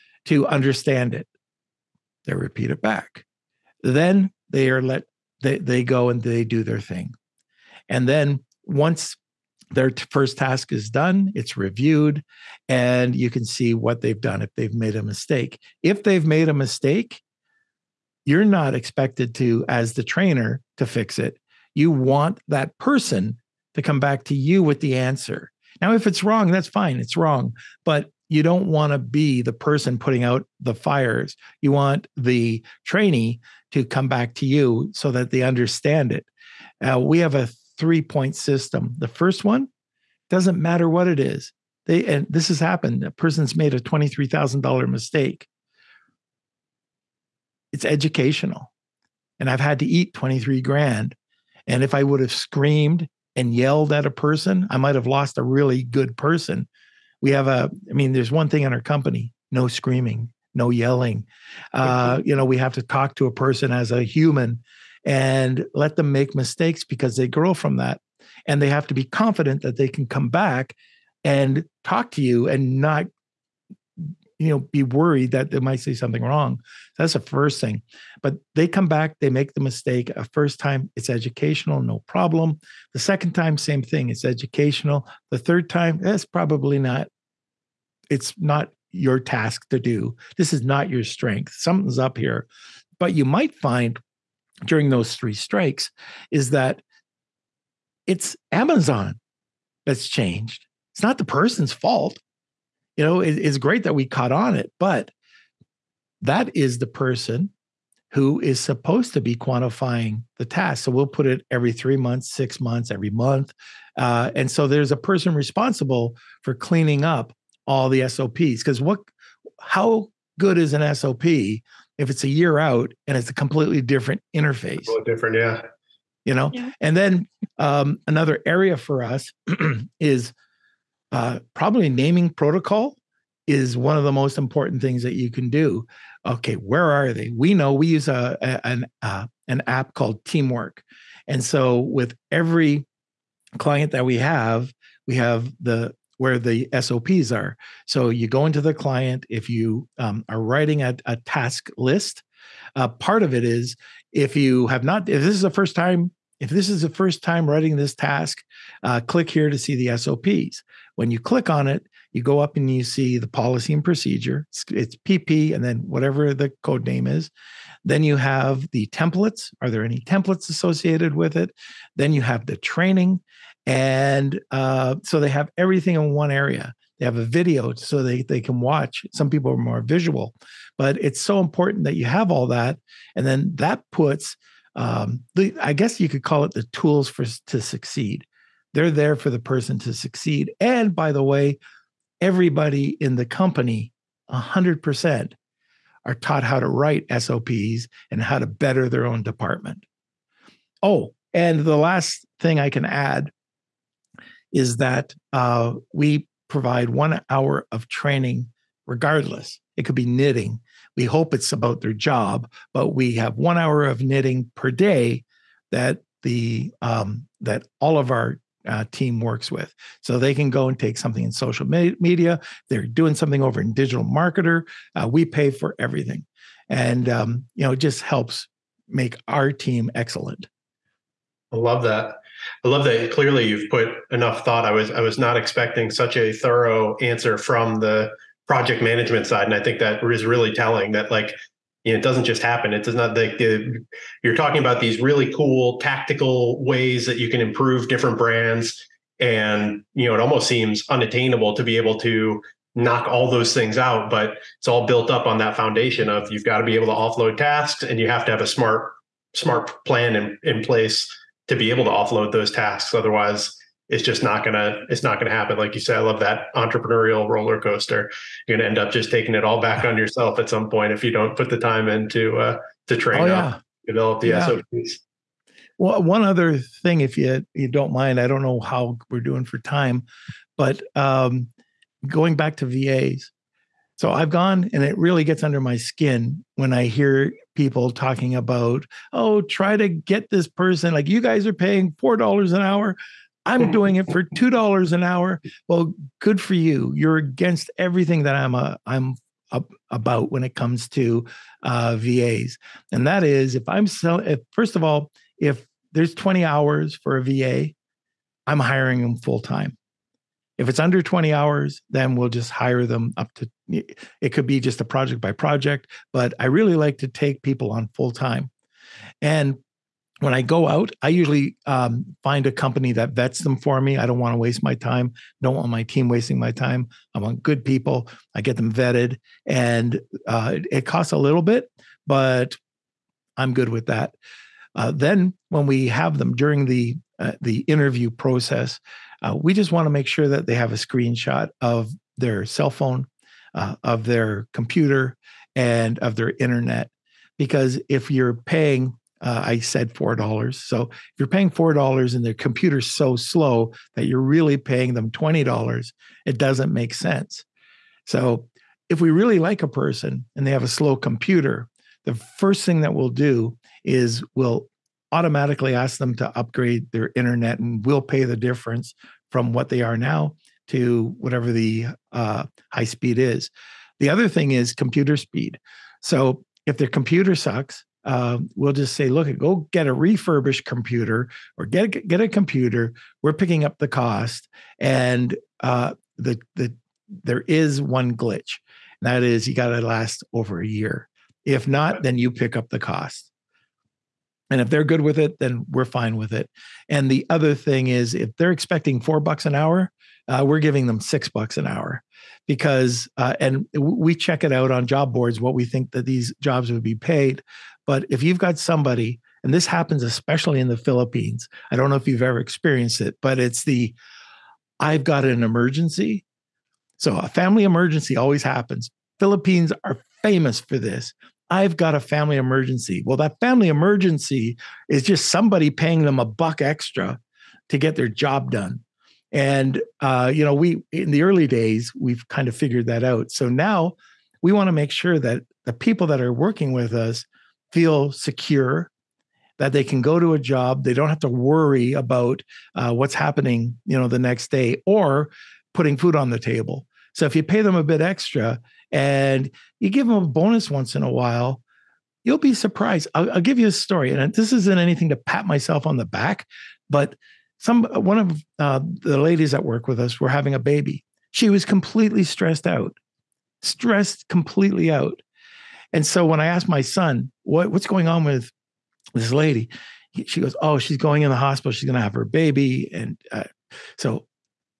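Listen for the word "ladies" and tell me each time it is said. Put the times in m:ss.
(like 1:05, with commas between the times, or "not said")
7:39.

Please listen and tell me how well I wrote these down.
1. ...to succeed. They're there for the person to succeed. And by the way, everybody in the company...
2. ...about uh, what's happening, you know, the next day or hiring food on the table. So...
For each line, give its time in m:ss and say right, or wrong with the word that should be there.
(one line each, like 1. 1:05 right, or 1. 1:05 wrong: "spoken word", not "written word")
1. 3:07 right
2. 7:21 wrong: "putting", not "hiring".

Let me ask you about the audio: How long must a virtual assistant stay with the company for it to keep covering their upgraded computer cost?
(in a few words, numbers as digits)
over a year.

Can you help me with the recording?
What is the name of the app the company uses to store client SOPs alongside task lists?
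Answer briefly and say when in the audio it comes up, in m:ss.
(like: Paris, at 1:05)
Teamwork, at 2:20.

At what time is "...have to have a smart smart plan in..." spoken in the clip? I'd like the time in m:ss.
4:18.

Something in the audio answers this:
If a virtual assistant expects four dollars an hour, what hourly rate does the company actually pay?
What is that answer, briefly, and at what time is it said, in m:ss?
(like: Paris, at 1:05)
$6, at 6:41.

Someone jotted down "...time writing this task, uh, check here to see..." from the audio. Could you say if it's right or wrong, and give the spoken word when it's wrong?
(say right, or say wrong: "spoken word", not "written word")
wrong: "click", not "check".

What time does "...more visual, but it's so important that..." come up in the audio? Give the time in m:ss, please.
2:59.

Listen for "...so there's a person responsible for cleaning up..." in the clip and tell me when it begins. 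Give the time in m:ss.
1:54.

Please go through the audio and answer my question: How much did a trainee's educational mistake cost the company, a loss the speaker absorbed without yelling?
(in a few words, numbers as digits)
$23,000.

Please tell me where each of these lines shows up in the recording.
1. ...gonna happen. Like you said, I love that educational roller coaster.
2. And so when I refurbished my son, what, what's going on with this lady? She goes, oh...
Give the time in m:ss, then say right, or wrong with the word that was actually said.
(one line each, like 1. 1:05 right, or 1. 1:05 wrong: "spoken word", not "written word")
1. 4:25 wrong: "entrepreneurial", not "educational"
2. 7:45 wrong: "asked", not "refurbished".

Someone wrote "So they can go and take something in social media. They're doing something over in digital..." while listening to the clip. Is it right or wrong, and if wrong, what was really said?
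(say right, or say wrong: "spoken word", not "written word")
right.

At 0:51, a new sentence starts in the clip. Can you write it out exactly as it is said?
And if I would have screamed and yelled at a person, I might have lost a really good person.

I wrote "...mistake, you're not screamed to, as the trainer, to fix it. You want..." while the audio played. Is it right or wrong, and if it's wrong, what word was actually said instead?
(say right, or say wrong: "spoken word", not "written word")
wrong: "expected", not "screamed".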